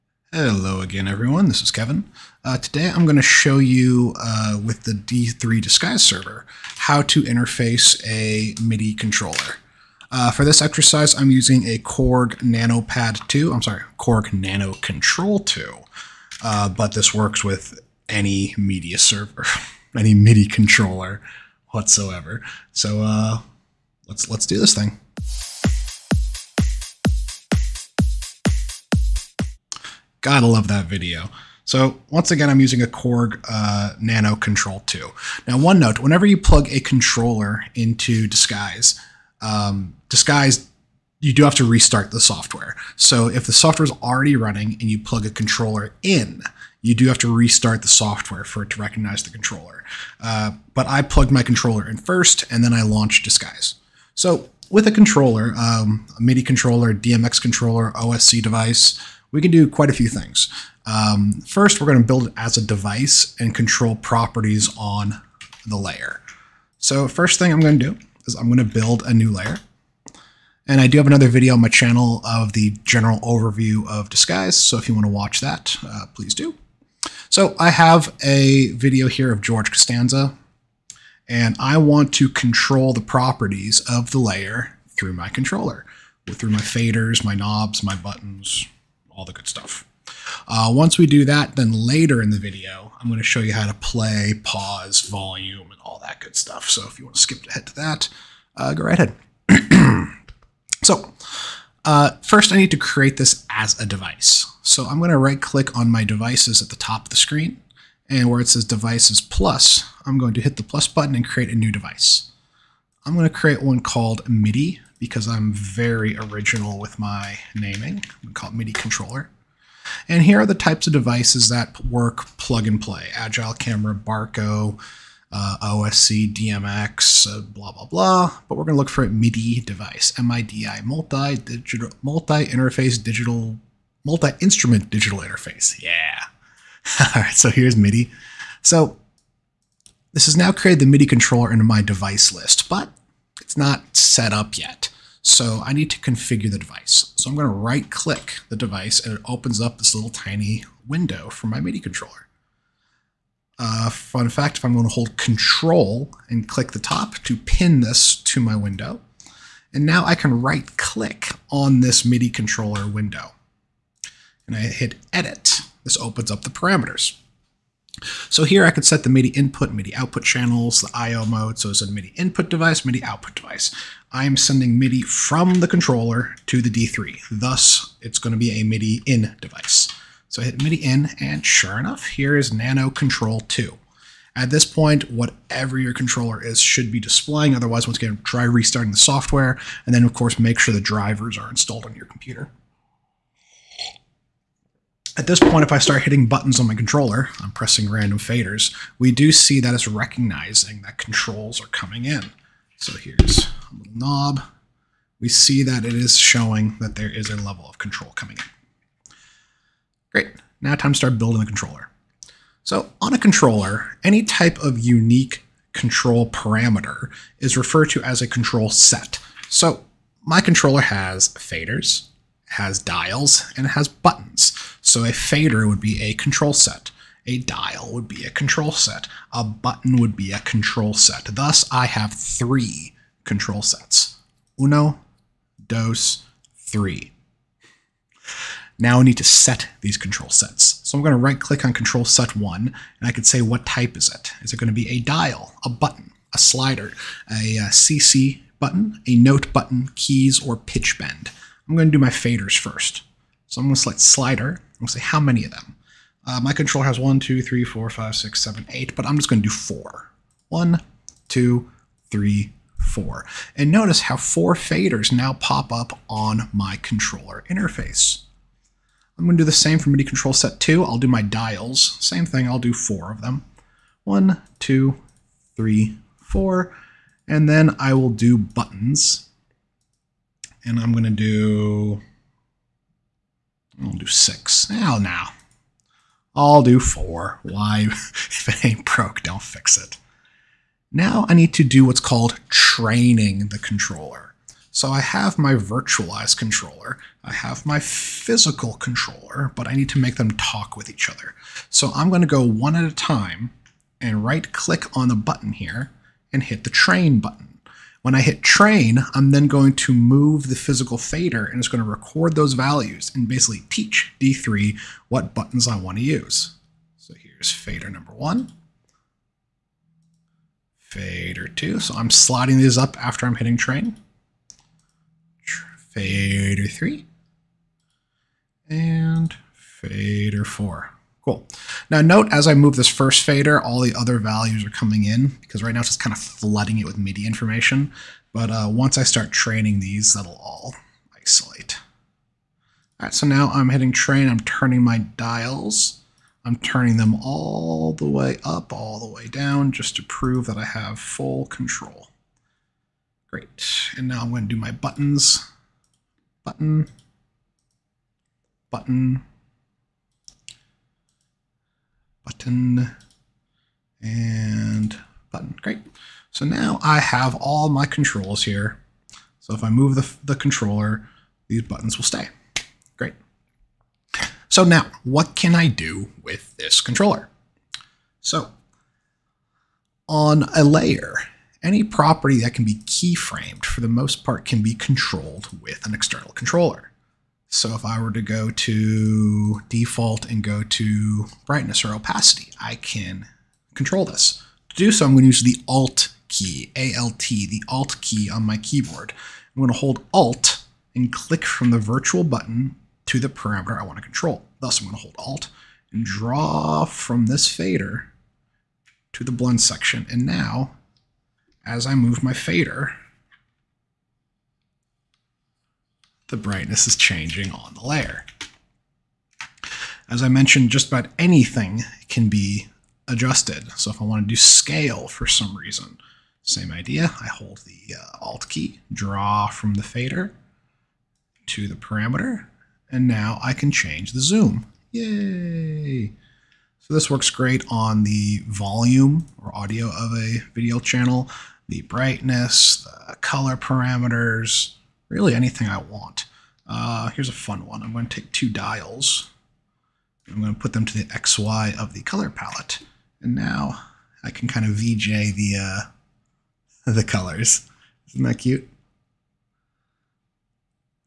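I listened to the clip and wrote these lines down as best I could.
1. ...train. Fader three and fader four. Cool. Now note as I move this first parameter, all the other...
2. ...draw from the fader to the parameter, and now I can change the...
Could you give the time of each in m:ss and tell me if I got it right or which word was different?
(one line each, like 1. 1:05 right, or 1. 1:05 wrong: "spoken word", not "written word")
1. 5:23 wrong: "fader", not "parameter"
2. 7:08 right.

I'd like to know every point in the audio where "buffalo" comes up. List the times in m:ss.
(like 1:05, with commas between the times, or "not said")
not said.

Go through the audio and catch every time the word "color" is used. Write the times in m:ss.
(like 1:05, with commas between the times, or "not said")
7:23, 7:32, 7:37.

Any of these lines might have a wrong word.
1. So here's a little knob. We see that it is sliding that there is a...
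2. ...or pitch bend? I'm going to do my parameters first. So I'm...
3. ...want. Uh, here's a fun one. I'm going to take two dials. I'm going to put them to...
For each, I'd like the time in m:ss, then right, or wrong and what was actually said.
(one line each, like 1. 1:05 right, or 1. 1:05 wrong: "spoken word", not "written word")
1. 3:22 wrong: "showing", not "sliding"
2. 4:10 wrong: "faders", not "parameters"
3. 7:25 right.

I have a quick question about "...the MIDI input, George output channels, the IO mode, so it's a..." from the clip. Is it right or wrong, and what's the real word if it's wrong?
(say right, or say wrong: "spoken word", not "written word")
wrong: "MIDI", not "George".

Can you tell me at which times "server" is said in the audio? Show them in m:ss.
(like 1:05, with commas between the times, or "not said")
0:06, 0:18.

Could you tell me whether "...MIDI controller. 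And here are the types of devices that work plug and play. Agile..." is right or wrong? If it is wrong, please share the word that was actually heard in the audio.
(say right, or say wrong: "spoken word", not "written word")
right.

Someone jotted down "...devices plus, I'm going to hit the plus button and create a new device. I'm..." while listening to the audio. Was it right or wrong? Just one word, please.
right.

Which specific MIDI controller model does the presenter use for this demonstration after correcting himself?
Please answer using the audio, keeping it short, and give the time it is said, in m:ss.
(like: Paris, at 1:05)
Korg NanoKontrol2, at 0:13.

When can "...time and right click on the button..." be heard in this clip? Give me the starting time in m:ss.
5:02.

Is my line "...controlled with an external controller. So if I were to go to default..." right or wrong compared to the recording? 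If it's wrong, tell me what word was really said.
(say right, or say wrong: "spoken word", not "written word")
right.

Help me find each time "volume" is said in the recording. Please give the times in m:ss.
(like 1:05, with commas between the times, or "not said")
1:35, 7:18.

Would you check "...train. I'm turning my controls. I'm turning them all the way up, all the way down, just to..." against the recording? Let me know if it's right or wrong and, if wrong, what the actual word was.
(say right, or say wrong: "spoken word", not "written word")
wrong: "dials", not "controls".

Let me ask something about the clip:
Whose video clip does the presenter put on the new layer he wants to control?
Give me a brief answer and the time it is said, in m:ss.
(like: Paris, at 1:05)
George Costanza, at 1:19.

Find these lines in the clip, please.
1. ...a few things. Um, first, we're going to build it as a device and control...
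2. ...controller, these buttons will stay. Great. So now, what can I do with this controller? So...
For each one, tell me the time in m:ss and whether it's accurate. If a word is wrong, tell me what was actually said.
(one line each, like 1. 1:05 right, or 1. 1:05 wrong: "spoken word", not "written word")
1. 0:59 right
2. 6:10 right.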